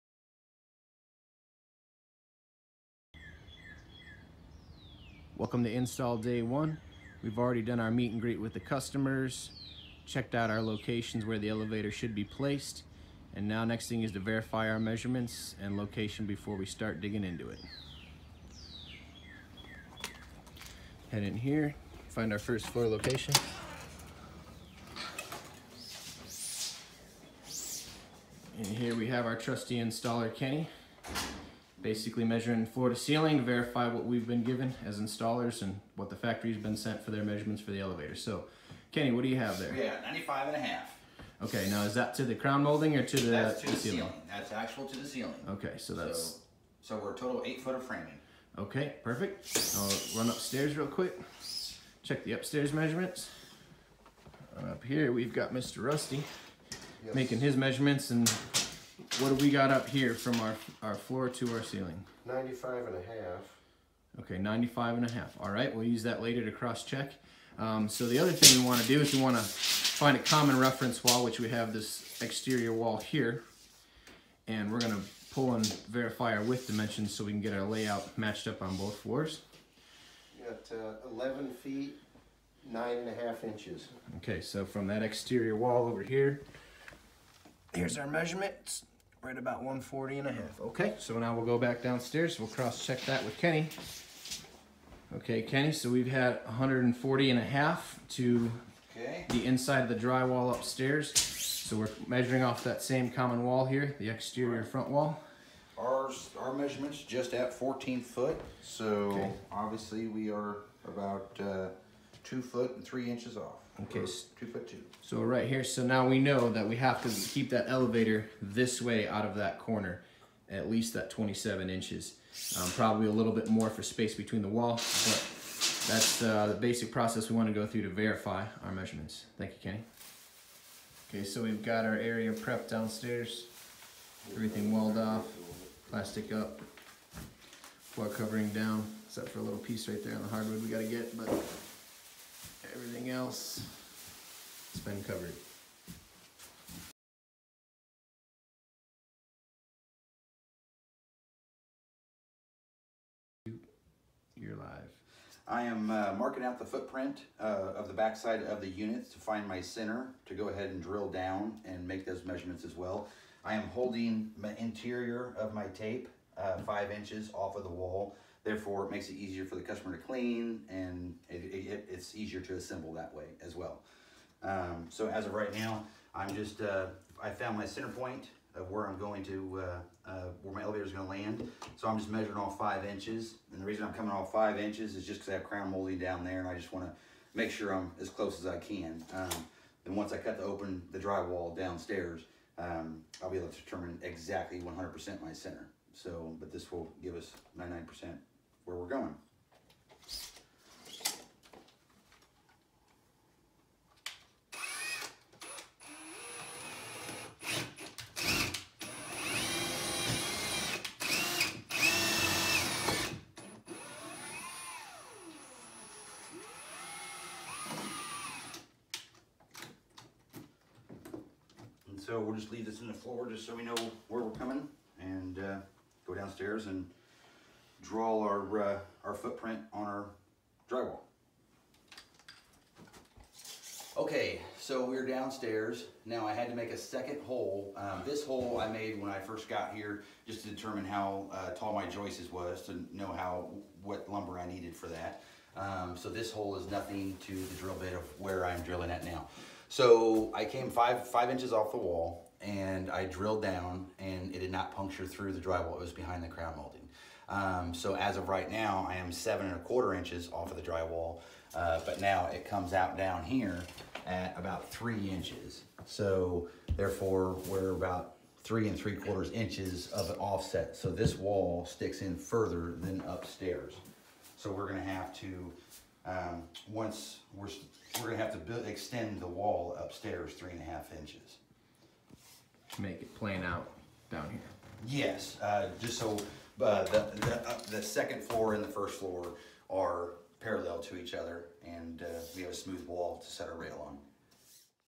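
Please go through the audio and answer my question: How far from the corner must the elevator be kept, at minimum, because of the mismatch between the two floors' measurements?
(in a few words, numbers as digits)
27 inches.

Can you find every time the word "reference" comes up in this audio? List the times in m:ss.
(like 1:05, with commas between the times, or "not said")
1:10.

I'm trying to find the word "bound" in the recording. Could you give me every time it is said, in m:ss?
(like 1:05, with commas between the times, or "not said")
not said.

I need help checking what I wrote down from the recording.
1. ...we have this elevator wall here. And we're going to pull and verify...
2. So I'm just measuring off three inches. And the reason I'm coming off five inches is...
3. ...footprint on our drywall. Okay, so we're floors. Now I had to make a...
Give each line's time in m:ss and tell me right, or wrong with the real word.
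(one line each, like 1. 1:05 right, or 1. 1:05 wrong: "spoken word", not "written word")
1. 1:11 wrong: "exterior", not "elevator"
2. 3:01 wrong: "five", not "three"
3. 3:49 wrong: "downstairs", not "floors".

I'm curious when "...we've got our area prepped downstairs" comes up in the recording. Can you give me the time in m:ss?
2:11.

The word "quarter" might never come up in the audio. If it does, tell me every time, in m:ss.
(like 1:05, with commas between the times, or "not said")
4:19, 4:28.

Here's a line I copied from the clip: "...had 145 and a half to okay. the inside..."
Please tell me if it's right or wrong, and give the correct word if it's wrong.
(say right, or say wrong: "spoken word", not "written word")
wrong: "140", not "145".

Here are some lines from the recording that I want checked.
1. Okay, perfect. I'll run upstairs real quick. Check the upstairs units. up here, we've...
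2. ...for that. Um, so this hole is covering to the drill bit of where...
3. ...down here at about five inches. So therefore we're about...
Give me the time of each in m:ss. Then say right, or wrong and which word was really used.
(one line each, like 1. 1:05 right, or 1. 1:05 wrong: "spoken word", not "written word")
1. 0:48 wrong: "measurements", not "units"
2. 4:04 wrong: "nothing", not "covering"
3. 4:22 wrong: "three", not "five".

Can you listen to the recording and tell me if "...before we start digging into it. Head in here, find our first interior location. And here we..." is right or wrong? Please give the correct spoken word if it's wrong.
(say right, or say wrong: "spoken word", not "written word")
wrong: "floor", not "interior".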